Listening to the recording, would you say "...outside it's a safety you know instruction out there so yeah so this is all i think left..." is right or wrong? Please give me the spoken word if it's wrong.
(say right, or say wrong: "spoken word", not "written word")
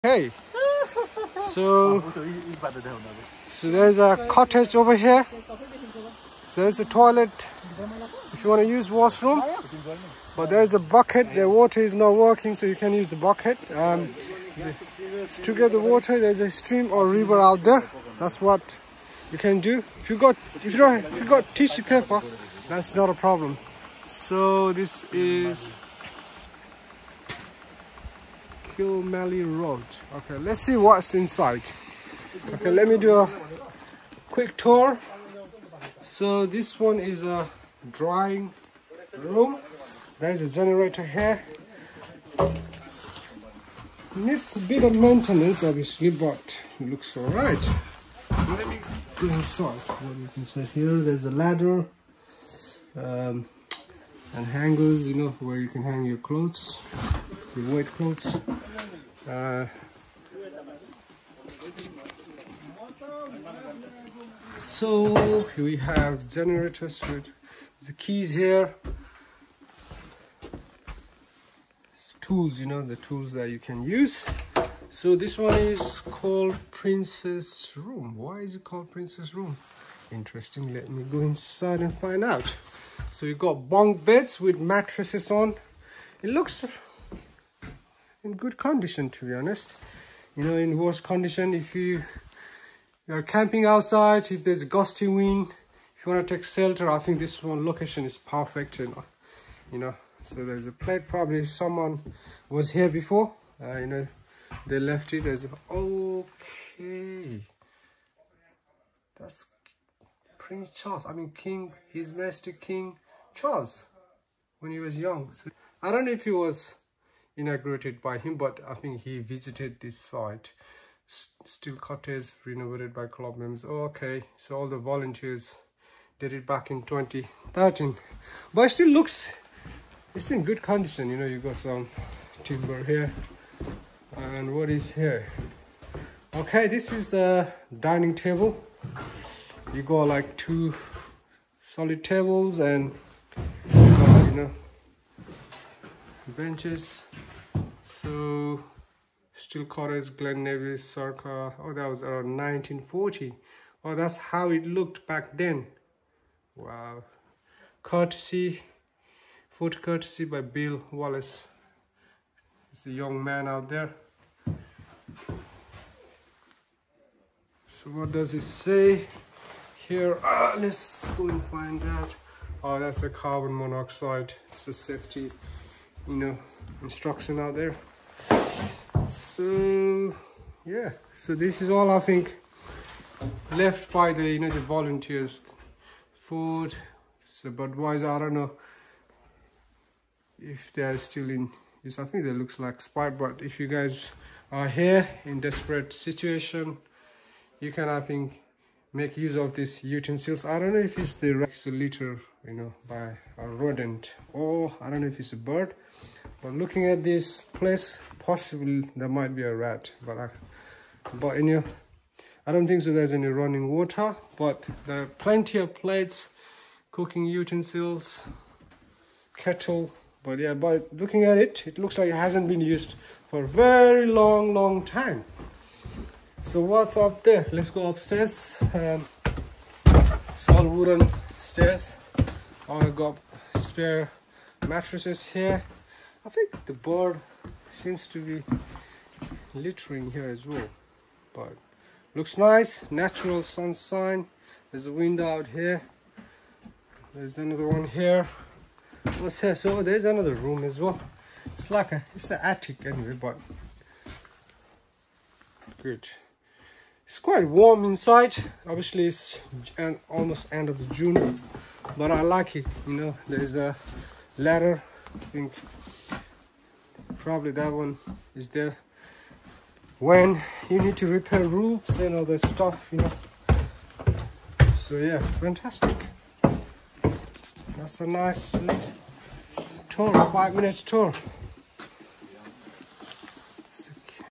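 wrong: "monoxide", not "outside".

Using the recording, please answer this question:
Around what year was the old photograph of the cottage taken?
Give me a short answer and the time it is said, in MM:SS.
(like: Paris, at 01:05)
1940, at 02:32.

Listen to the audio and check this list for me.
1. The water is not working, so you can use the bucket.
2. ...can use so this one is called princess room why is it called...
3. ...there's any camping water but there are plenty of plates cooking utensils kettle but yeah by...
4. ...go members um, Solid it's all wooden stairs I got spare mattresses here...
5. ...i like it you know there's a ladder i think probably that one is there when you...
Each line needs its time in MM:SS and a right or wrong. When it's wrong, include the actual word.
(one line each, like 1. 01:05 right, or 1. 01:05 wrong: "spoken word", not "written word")
1. 00:11 right
2. 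01:13 right
3. 03:32 wrong: "running", not "camping"
4. 03:47 wrong: "upstairs", not "members"
5. 04:22 right.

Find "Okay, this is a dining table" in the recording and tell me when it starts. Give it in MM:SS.
02:16.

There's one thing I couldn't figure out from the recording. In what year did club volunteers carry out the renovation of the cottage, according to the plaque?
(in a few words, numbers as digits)
2013.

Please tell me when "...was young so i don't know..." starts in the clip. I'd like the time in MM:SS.
01:54.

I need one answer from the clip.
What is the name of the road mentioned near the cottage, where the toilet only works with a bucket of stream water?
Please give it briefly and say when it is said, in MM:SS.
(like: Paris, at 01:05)
Kilmelly Road, at 00:28.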